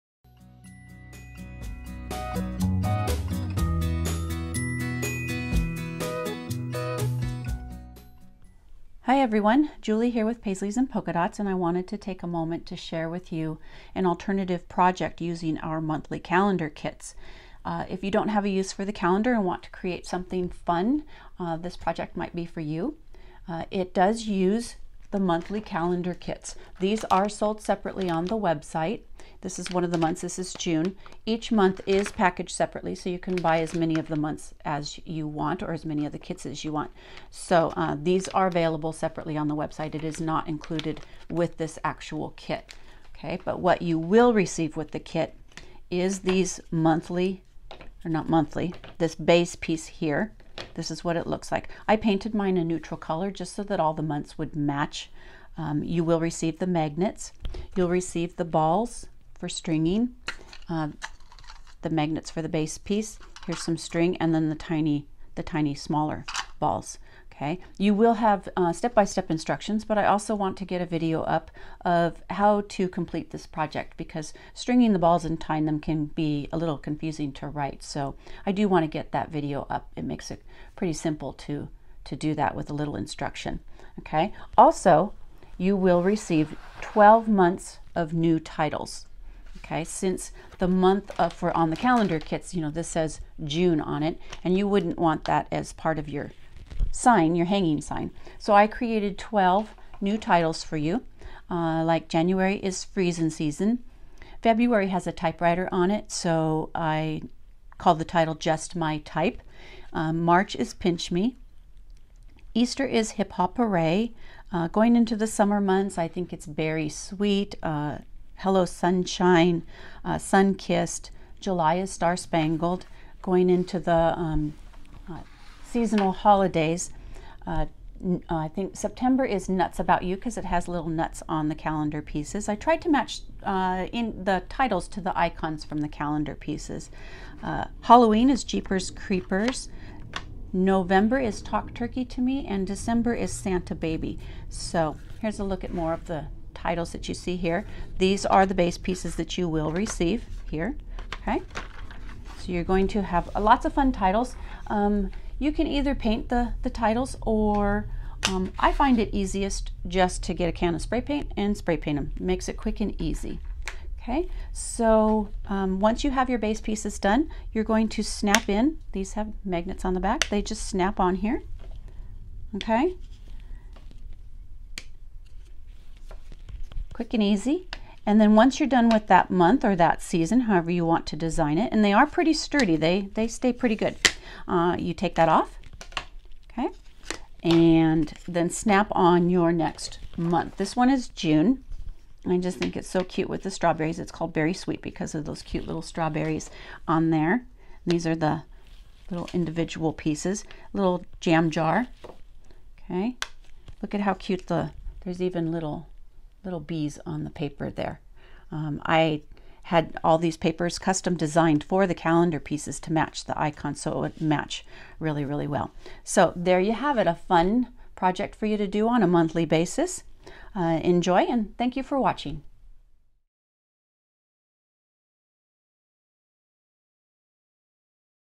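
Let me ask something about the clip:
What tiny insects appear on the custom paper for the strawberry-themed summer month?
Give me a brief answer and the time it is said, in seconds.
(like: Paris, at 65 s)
Bees, at 206 s.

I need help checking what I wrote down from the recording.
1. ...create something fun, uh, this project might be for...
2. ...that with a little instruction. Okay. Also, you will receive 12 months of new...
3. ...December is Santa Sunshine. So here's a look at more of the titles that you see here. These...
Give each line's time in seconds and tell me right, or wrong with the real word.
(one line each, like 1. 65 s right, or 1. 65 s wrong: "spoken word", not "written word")
1. 19 s right
2. 82 s right
3. 142 s wrong: "Baby", not "Sunshine".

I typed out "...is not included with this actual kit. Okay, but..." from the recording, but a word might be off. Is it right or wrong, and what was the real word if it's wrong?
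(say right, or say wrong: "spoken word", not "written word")
right.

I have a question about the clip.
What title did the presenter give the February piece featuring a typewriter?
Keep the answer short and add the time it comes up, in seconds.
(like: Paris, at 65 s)
Just My Type, at 108 s.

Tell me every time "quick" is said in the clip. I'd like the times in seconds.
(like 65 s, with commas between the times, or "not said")
162 s, 177 s.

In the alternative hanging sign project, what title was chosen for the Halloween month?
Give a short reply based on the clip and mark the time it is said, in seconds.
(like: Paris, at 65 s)
Jeepers Creepers, at 138 s.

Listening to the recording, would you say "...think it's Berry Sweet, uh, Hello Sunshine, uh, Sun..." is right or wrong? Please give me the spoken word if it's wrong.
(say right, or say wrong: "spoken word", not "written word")
right.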